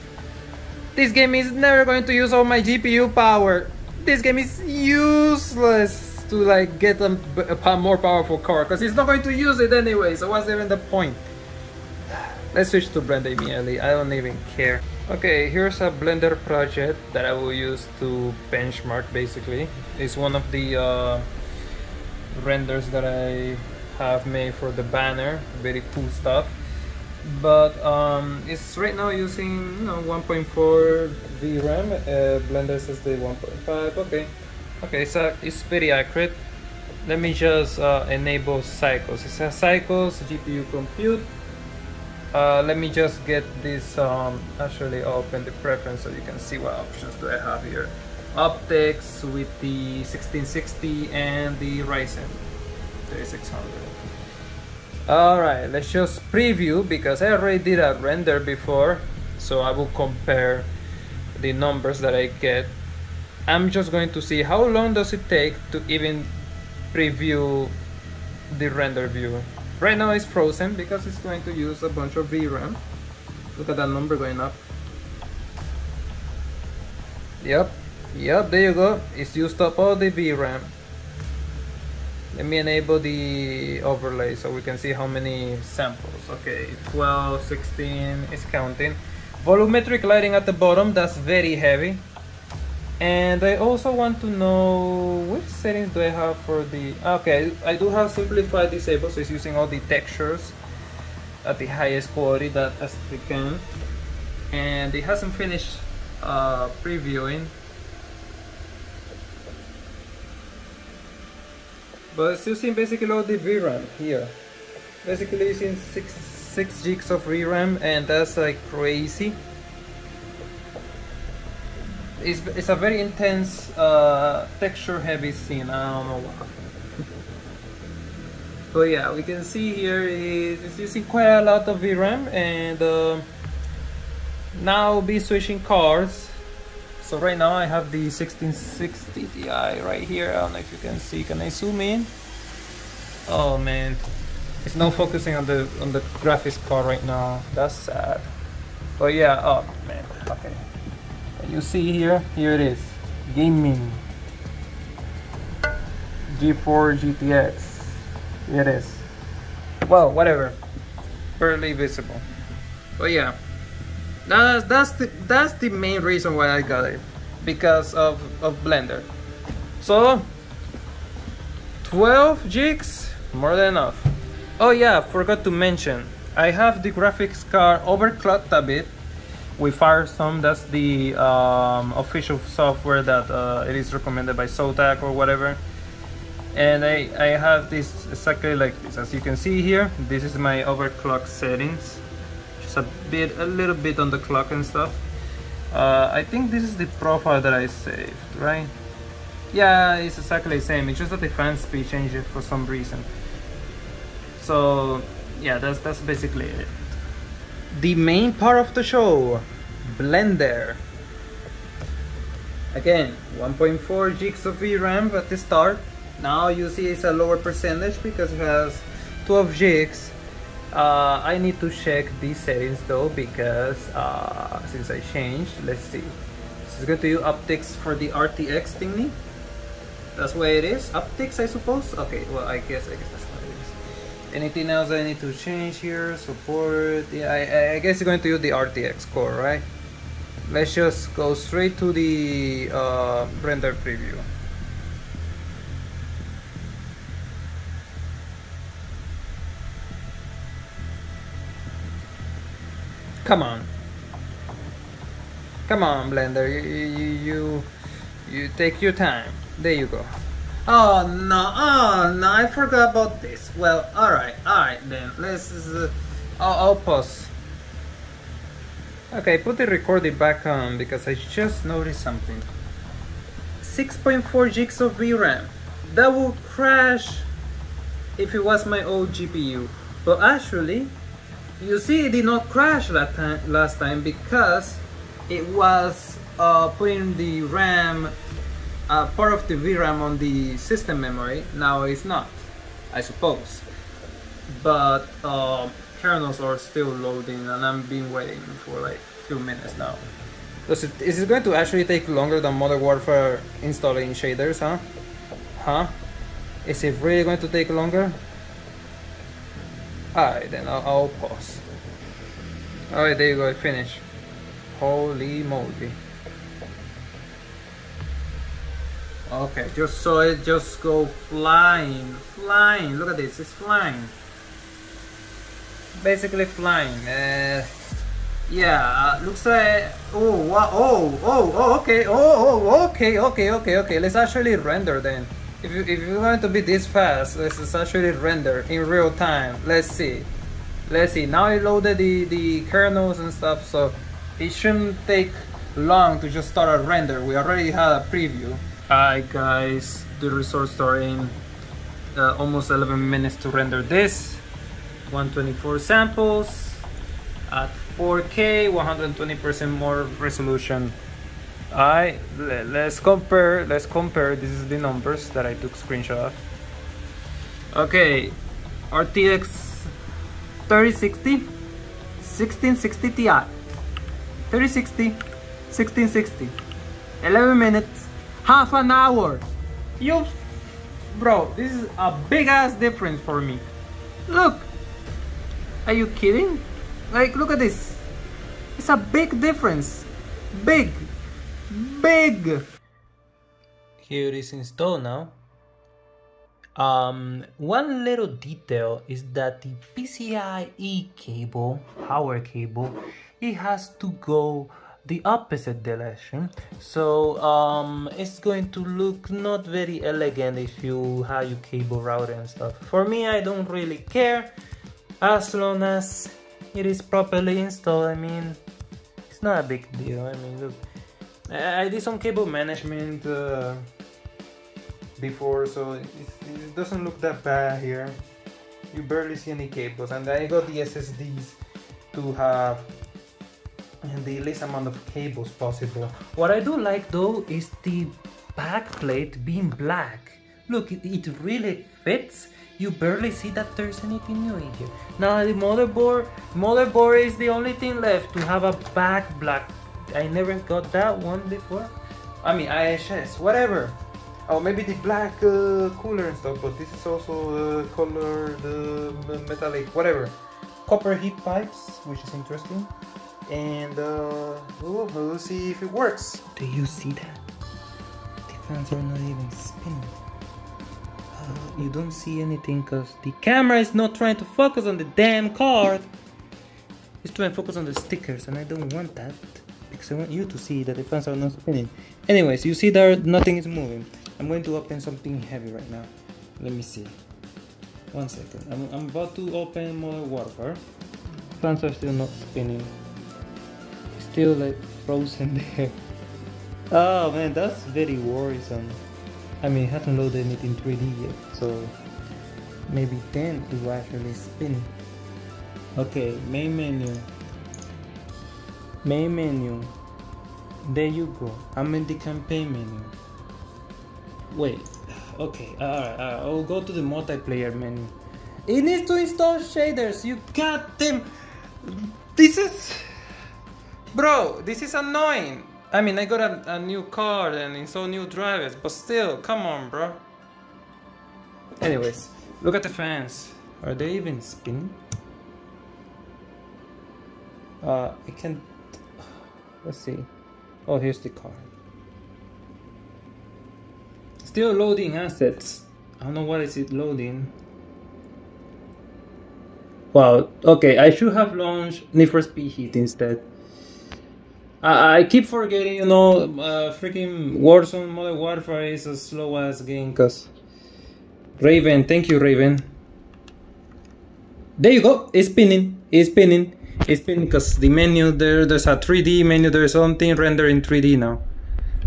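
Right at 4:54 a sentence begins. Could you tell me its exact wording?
But uh, kernels are still loading and I've been waiting for like few minutes now.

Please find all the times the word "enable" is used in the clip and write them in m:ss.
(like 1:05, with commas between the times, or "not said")
0:38, 1:22.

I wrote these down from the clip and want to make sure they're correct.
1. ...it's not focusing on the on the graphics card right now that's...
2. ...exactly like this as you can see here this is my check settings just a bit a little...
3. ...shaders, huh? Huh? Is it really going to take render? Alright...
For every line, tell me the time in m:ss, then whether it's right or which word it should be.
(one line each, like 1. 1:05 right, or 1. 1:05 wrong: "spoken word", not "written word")
1. 2:24 right
2. 3:08 wrong: "overclock", not "check"
3. 5:04 wrong: "longer", not "render".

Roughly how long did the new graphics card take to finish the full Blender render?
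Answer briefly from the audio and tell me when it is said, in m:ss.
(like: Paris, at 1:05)
11 minutes, at 5:52.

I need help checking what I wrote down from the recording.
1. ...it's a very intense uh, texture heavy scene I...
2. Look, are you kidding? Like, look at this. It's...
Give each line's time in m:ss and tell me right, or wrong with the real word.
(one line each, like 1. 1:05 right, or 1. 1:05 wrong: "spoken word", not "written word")
1. 2:02 right
2. 6:24 right.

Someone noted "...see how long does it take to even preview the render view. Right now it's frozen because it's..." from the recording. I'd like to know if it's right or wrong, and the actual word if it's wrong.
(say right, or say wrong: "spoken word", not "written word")
right.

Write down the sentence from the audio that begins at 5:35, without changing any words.
If you if you want to be this fast, let's actually render in real time.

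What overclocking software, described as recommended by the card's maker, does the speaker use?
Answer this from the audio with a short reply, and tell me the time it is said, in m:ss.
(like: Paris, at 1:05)
FireStorm, at 2:59.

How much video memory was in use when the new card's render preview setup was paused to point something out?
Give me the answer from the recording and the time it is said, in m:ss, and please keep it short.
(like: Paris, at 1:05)
6.4 gigs, at 4:33.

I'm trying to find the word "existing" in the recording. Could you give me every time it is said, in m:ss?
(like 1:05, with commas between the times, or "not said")
not said.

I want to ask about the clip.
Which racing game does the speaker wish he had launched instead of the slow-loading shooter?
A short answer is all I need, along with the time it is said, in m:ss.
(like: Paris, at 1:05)
Need for Speed Heat, at 9:12.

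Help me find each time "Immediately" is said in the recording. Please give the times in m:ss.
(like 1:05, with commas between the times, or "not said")
0:13.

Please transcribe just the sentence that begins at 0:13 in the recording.
I don't even care Okay, here's a Blender project that I will use to benchmark basically.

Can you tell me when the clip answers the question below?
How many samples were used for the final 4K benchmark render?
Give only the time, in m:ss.
5:55.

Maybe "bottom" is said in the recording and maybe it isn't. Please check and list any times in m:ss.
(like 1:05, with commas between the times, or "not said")
1:30.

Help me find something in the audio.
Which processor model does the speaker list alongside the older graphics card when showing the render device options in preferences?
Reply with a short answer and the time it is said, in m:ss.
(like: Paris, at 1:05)
Ryzen 3600, at 0:51.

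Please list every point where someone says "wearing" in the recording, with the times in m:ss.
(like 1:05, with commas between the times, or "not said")
not said.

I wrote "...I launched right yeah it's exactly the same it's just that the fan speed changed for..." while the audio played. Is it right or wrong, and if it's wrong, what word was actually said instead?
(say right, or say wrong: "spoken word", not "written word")
wrong: "saved", not "launched".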